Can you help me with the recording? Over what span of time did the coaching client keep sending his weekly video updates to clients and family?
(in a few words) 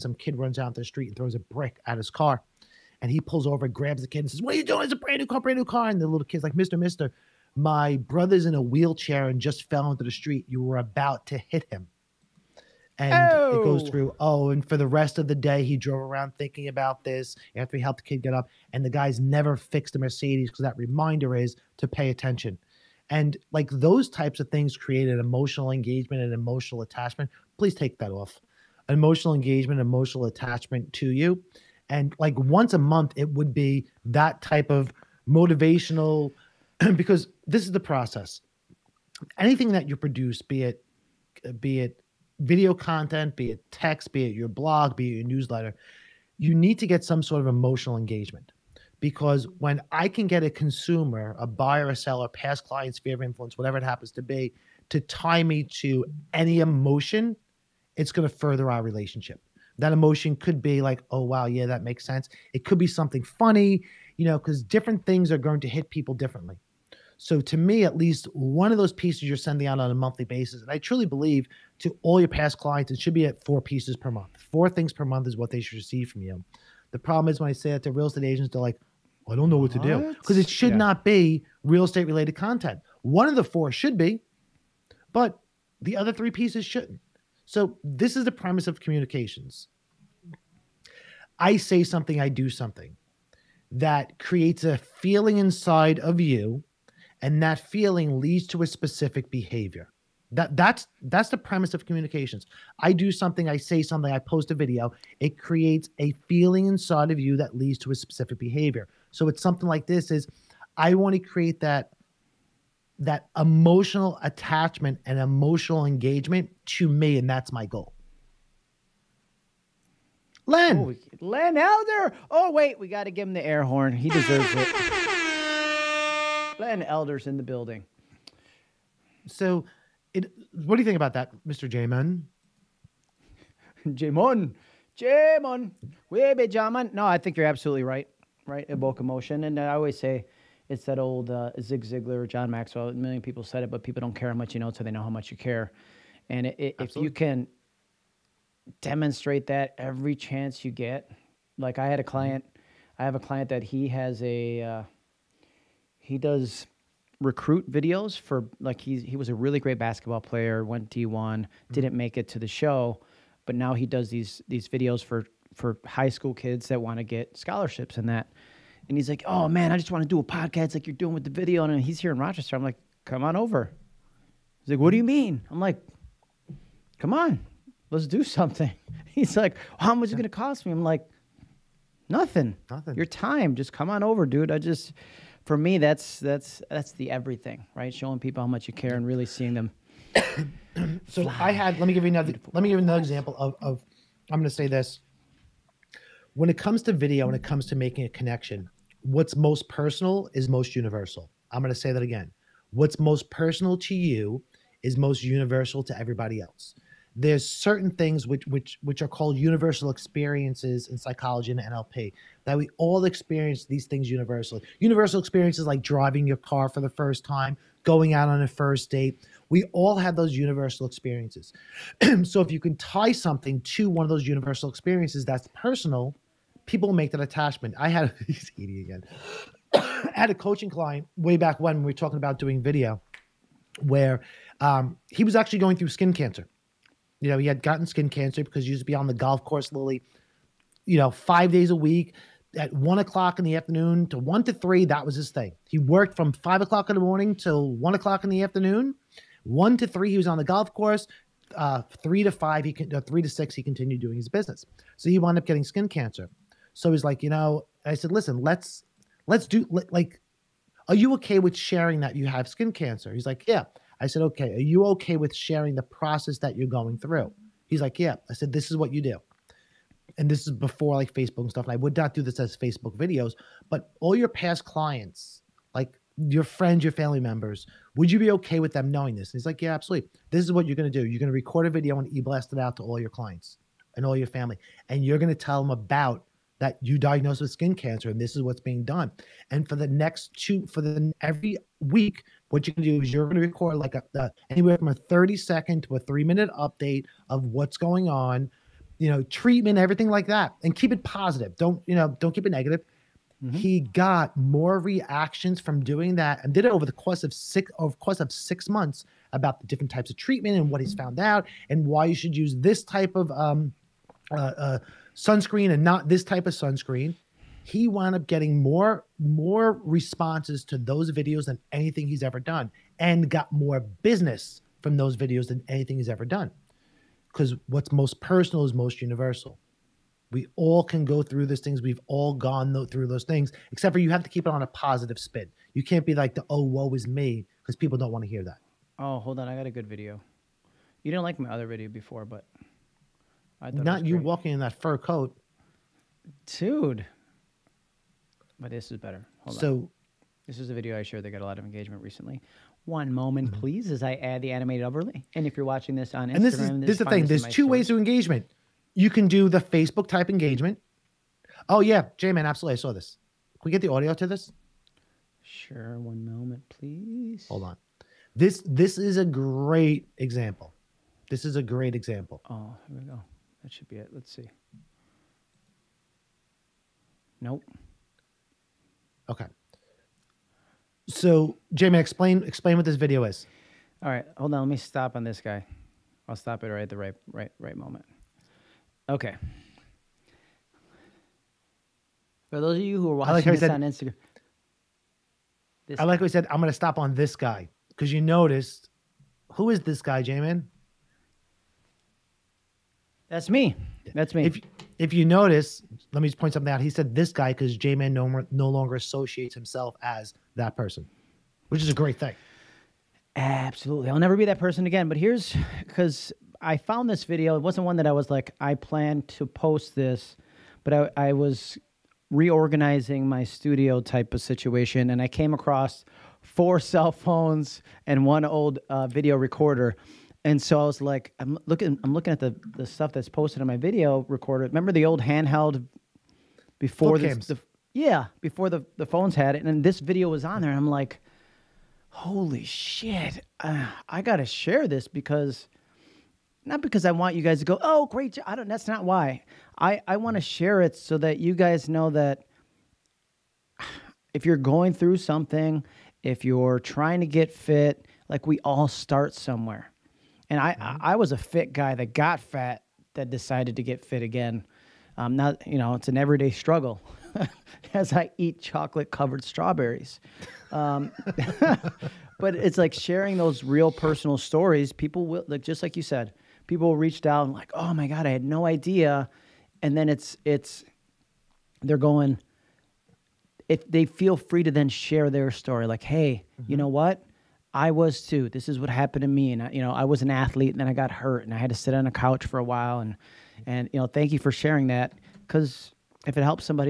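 6 months.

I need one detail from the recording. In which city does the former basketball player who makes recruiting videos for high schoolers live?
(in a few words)
Rochester.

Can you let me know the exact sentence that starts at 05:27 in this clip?
Because what's most personal is most universal.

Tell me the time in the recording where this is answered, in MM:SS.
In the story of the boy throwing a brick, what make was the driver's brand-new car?
00:19.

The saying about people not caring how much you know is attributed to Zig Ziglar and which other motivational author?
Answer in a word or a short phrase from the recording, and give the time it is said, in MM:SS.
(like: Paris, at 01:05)
John Maxwell, at 02:22.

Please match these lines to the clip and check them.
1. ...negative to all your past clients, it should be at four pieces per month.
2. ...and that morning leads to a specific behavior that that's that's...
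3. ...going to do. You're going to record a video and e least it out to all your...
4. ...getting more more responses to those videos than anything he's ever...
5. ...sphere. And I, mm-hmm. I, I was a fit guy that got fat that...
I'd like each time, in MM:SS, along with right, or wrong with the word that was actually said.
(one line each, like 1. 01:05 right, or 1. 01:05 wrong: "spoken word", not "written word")
1. 01:11 wrong: "believe", not "negative"
2. 01:37 wrong: "feeling", not "morning"
3. 04:40 wrong: "blast", not "least"
4. 05:18 right
5. 07:39 wrong: "somewhere", not "sphere".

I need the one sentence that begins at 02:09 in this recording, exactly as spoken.
So, it, what do you think about that, Mr.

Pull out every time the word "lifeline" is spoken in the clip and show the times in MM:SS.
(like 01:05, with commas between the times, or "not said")
not said.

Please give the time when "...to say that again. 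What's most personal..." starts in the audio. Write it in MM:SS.
03:21.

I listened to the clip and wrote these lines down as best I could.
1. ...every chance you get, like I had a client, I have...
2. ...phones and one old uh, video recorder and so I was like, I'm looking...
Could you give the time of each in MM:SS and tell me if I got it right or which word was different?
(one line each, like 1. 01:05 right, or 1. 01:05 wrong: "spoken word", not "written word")
1. 02:29 right
2. 07:07 right.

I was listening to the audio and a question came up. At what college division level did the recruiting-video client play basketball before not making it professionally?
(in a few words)
D1.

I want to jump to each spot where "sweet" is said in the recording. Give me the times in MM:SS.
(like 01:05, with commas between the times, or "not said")
not said.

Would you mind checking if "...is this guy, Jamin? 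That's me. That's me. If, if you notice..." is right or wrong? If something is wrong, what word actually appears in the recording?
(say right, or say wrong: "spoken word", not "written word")
right.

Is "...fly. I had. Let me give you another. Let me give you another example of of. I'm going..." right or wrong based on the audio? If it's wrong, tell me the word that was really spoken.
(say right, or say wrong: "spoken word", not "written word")
right.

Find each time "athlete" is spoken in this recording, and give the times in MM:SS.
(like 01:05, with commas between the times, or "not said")
08:10.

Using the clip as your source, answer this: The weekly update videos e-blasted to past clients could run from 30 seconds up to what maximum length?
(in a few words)
3 minutes.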